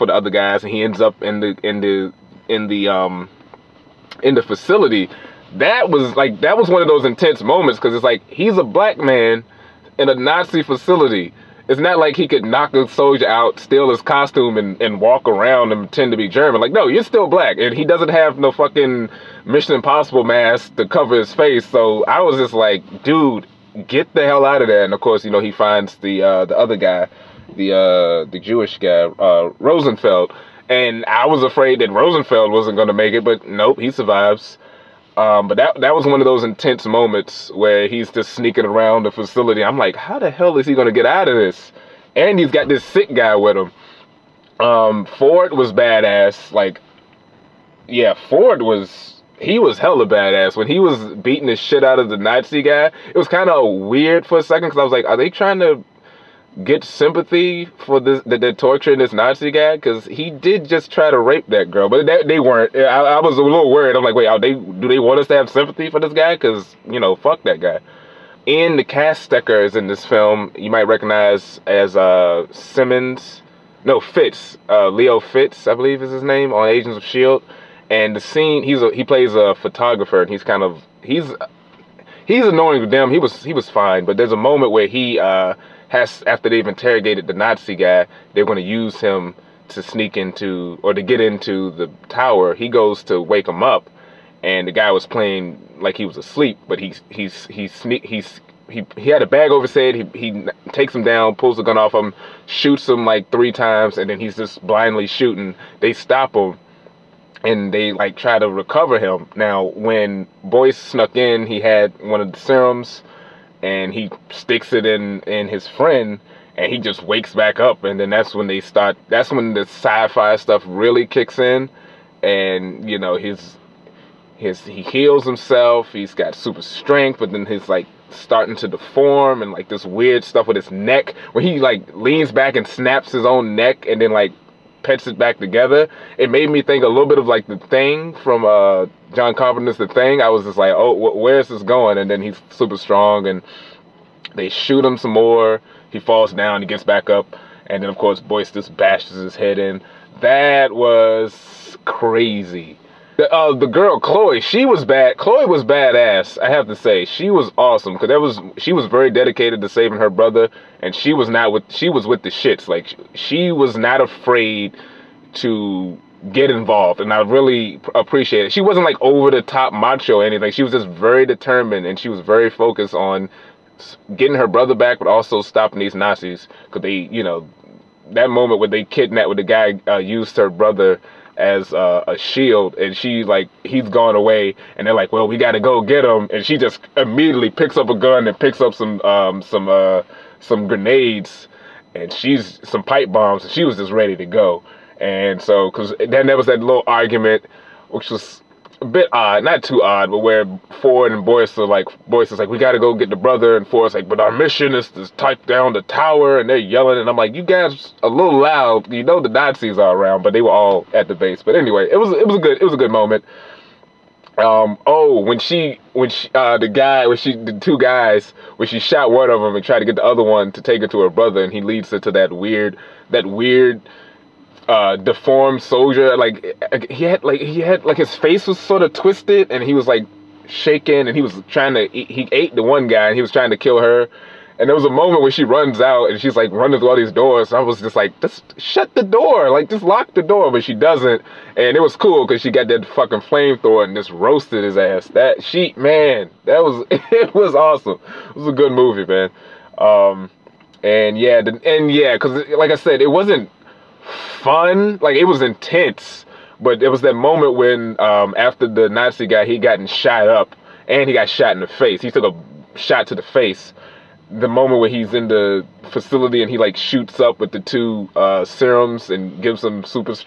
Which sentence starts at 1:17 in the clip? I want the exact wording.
And the scene, he's a, he plays a photographer, and he's kind of he's he's annoying to them.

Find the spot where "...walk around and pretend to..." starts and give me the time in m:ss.
0:15.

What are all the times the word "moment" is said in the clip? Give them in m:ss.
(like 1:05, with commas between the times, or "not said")
0:07, 0:36, 1:24, 2:58, 3:32, 3:54, 4:17, 4:24.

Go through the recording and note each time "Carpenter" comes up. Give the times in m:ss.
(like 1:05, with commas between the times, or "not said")
2:19.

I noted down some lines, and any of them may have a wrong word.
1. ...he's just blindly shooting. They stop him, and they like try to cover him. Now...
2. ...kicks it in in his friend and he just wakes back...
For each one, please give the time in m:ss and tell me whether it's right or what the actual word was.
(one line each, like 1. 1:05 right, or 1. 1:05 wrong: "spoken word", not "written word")
1. 1:44 wrong: "recover", not "cover"
2. 1:54 wrong: "sticks", not "kicks".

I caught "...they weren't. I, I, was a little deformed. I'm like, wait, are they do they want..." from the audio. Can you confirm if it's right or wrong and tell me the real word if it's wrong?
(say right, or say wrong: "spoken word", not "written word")
wrong: "worried", not "deformed".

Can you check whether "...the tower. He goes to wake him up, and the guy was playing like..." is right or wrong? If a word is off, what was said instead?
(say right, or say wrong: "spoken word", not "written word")
right.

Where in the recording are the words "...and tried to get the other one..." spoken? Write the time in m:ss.
3:39.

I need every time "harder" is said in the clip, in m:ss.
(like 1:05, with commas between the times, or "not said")
not said.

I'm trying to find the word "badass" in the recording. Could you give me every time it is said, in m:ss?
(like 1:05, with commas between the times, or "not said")
0:45, 0:50, 2:35.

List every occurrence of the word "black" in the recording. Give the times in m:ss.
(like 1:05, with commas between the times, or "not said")
0:08, 0:17.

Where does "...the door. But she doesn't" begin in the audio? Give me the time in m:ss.
4:00.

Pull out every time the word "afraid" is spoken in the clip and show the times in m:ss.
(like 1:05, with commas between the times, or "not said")
0:31, 2:44.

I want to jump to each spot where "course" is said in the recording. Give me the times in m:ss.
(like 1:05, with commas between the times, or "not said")
0:25, 2:27.